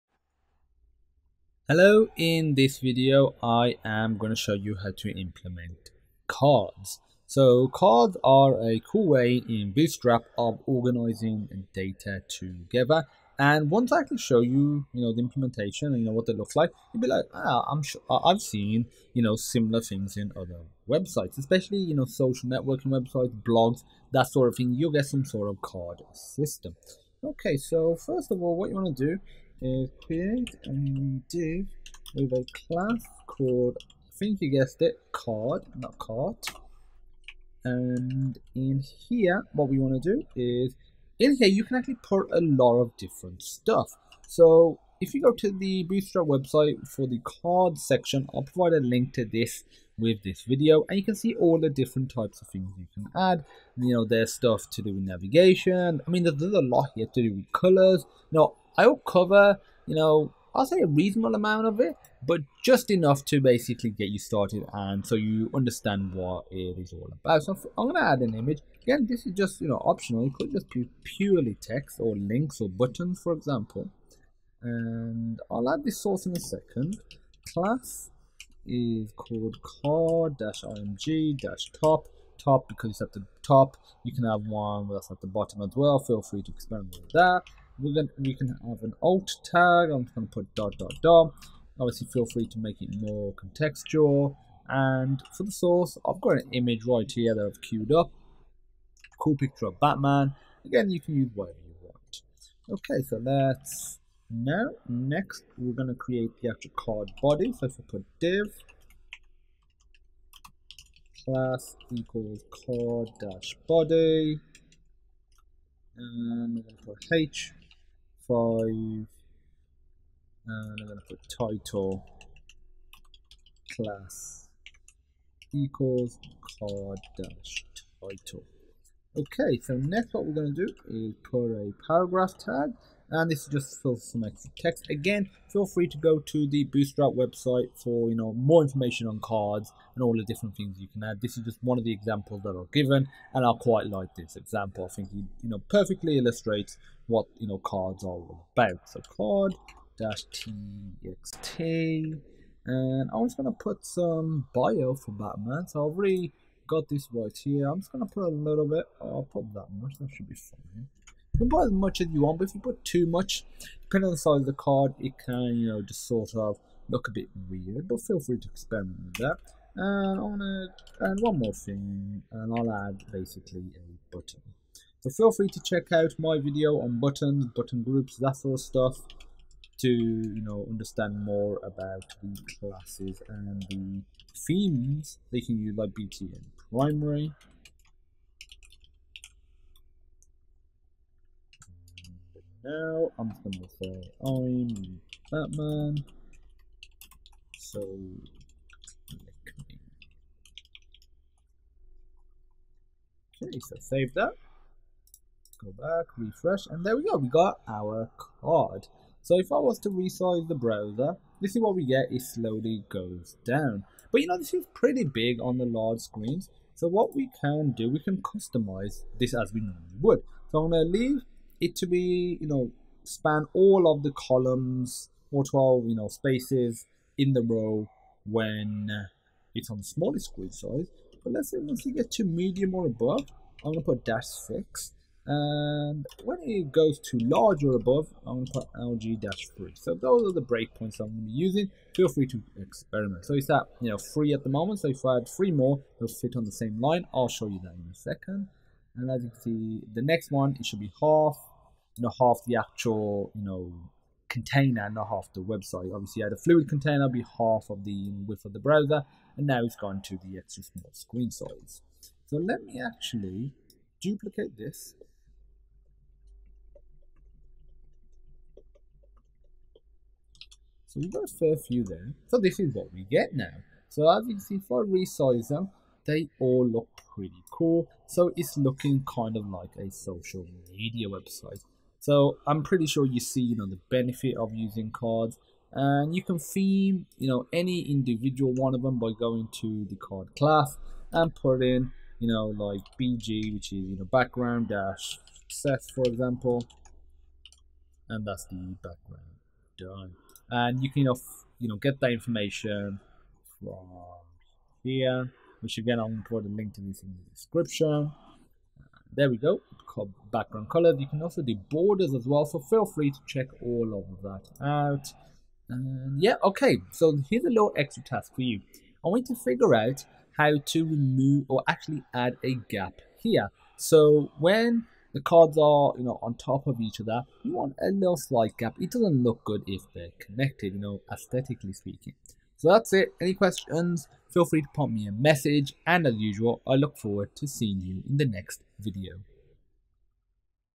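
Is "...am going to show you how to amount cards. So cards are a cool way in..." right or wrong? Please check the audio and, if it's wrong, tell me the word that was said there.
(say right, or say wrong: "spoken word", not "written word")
wrong: "implement", not "amount".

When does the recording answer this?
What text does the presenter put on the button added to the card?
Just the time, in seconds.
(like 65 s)
194 s.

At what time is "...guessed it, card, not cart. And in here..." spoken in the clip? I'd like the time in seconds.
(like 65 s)
34 s.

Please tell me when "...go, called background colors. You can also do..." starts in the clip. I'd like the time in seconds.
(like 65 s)
309 s.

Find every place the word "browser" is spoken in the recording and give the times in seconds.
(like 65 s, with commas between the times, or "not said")
210 s, 258 s.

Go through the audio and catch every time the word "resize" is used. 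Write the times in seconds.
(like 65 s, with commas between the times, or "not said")
209 s, 274 s.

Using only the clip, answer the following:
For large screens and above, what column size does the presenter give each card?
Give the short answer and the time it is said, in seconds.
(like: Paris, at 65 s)
3, at 238 s.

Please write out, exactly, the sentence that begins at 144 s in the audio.
I think he you know perfectly illustrates what you know cards are all about.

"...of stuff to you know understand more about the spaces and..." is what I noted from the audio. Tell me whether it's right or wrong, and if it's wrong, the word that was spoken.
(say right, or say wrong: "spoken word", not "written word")
wrong: "classes", not "spaces".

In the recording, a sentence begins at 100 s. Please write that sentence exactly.
Again, you can use whatever you want.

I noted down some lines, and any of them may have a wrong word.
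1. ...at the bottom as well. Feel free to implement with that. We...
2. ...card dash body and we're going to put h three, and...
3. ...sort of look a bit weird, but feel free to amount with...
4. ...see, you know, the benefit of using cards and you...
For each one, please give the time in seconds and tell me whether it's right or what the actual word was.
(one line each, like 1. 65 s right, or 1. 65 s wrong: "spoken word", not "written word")
1. 85 s wrong: "experiment", not "implement"
2. 112 s wrong: "five", not "three"
3. 166 s wrong: "experiment", not "amount"
4. 283 s right.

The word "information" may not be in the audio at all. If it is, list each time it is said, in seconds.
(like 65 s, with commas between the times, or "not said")
138 s, 302 s.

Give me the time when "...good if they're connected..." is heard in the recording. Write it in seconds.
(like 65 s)
329 s.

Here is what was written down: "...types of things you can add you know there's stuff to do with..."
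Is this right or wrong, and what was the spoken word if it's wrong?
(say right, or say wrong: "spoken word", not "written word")
right.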